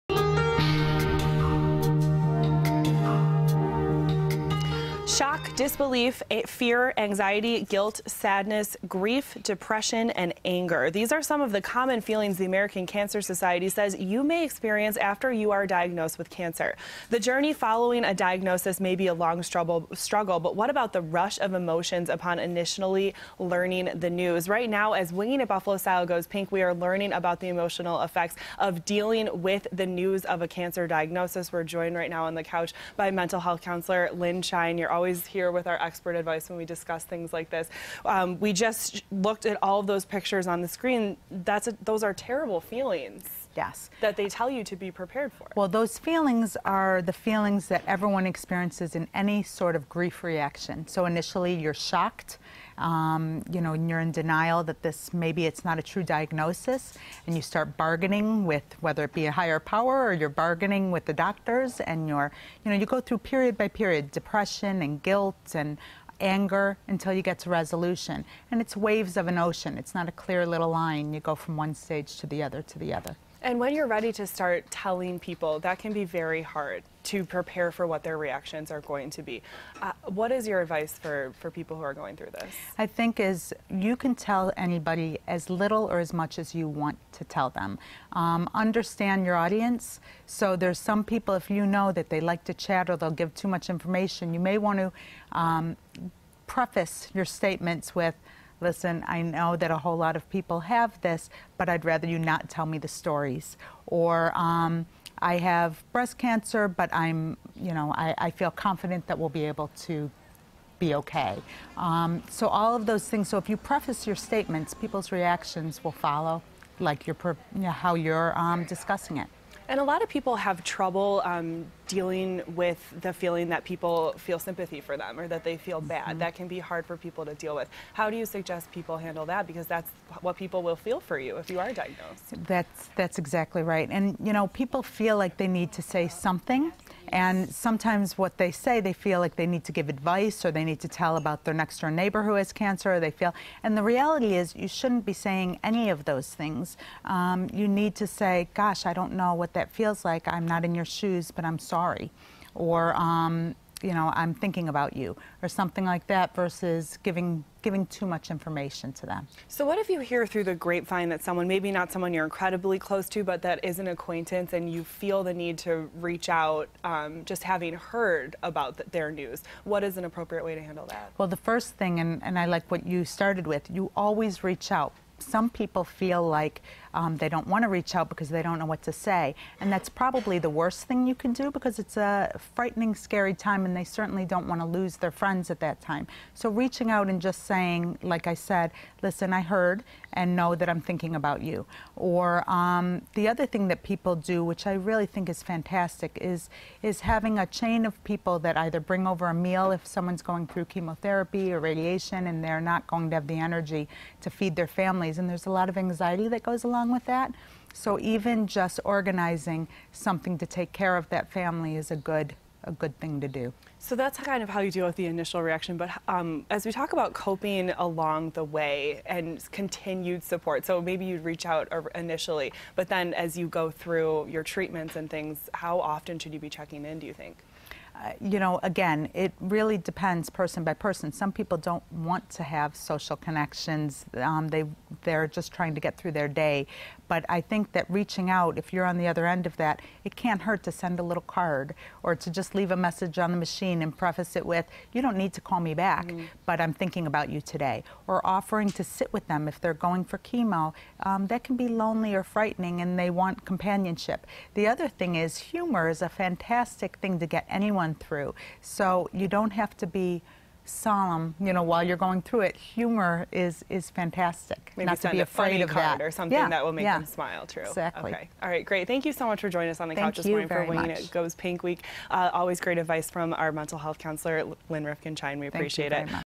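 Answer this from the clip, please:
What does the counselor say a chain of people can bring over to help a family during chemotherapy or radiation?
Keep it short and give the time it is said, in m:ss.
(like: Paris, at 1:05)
a meal, at 3:19.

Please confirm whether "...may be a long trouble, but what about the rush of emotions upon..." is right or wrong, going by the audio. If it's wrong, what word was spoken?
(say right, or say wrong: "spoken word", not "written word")
wrong: "struggle", not "trouble".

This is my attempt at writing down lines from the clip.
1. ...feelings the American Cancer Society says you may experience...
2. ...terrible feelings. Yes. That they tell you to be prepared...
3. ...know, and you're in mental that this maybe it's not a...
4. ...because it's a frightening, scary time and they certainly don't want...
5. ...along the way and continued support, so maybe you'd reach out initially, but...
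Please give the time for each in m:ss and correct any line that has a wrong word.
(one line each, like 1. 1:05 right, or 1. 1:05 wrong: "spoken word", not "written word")
1. 0:12 right
2. 0:42 right
3. 0:53 wrong: "denial", not "mental"
4. 3:01 right
5. 3:37 right.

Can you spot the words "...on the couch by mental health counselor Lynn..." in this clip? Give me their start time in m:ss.
0:32.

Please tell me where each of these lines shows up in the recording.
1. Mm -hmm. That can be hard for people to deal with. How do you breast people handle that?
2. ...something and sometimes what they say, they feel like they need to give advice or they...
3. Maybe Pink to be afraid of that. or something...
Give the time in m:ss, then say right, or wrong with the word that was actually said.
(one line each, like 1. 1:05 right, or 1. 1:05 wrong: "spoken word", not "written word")
1. 2:06 wrong: "suggest", not "breast"
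2. 2:16 right
3. 4:24 wrong: "Not", not "Pink".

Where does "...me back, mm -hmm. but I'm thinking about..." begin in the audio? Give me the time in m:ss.
4:05.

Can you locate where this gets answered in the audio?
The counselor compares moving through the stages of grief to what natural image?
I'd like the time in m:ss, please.
1:08.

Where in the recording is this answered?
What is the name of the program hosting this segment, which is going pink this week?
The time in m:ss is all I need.
0:25.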